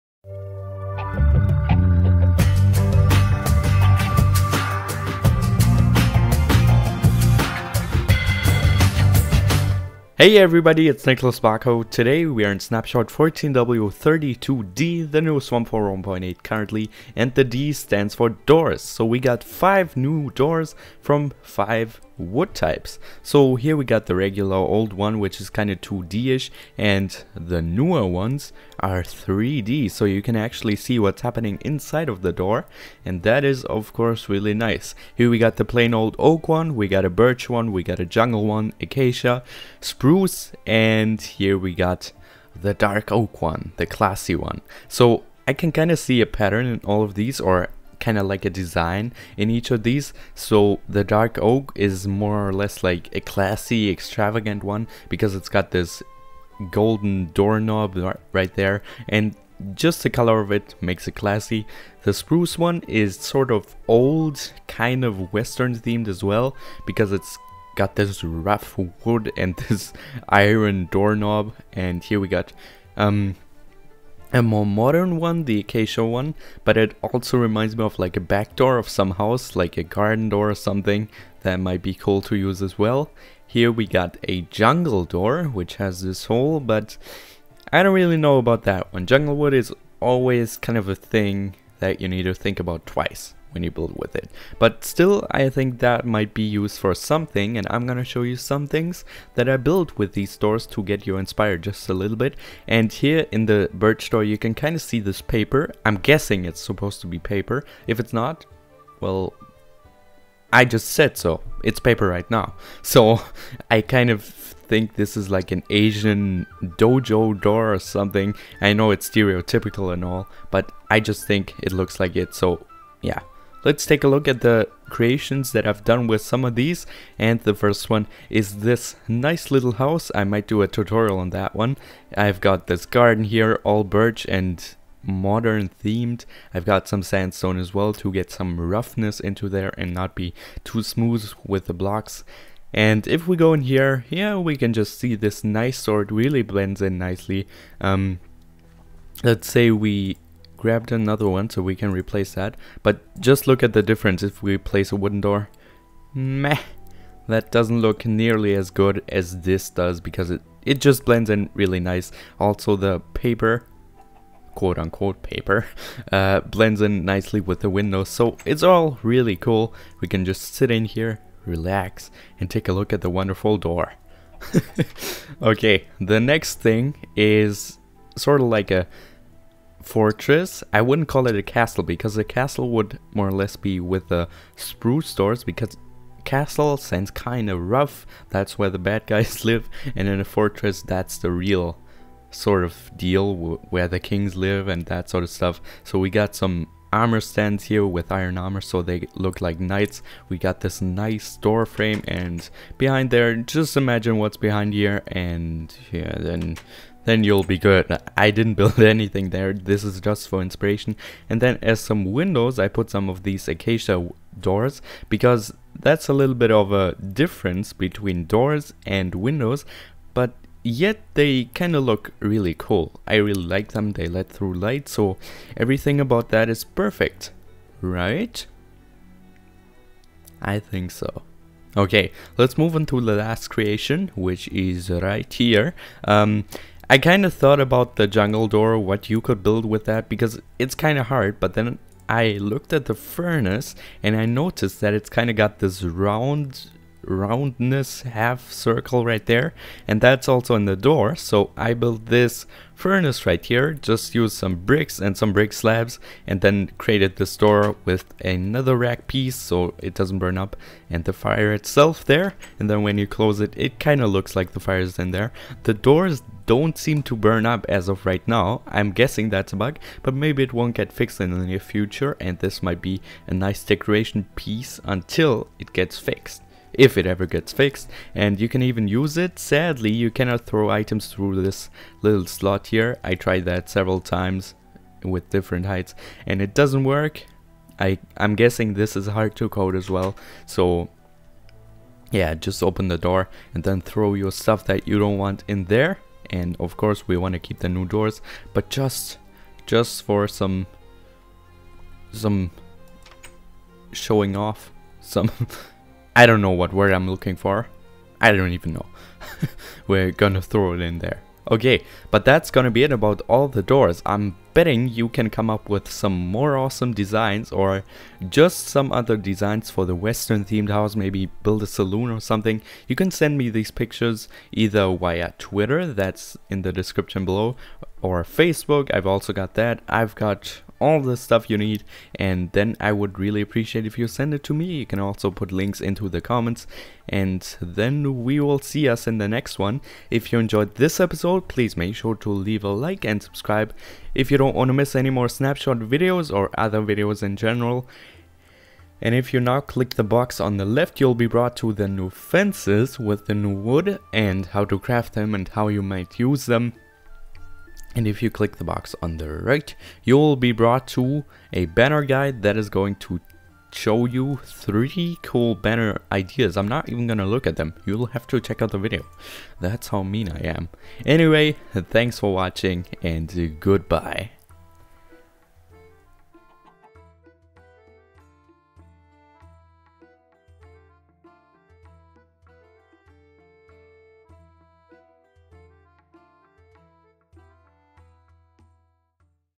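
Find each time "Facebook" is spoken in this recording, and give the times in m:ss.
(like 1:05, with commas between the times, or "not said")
5:28.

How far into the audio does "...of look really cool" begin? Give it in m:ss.
3:41.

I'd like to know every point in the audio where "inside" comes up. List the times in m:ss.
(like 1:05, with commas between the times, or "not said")
0:31.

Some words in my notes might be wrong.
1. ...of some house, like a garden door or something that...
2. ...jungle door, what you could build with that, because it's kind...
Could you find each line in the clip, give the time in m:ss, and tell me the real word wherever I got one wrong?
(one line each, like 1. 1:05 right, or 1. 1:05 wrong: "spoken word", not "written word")
1. 1:18 right
2. 3:58 right.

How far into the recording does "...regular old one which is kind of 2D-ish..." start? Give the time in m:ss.
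0:24.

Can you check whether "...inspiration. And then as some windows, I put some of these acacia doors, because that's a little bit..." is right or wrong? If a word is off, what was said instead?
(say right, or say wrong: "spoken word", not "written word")
right.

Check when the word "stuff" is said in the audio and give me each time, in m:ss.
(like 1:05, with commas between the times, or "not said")
3:15, 4:54, 5:31.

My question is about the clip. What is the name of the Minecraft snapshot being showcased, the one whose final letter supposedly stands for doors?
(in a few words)
14W32D.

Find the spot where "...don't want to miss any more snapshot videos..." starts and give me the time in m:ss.
5:44.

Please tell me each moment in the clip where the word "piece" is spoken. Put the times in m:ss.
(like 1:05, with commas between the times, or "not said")
4:19, 4:34.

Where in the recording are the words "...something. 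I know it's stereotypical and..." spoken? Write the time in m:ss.
1:57.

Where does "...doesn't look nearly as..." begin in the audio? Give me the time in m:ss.
2:37.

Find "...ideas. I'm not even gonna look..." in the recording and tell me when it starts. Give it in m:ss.
6:06.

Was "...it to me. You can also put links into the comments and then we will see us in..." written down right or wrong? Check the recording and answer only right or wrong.
right.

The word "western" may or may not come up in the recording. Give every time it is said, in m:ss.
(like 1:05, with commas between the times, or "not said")
1:05, 5:19.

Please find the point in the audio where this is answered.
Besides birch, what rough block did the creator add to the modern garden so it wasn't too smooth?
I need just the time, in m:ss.
2:17.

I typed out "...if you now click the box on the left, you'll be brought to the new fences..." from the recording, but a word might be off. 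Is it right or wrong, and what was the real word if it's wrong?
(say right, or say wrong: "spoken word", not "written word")
right.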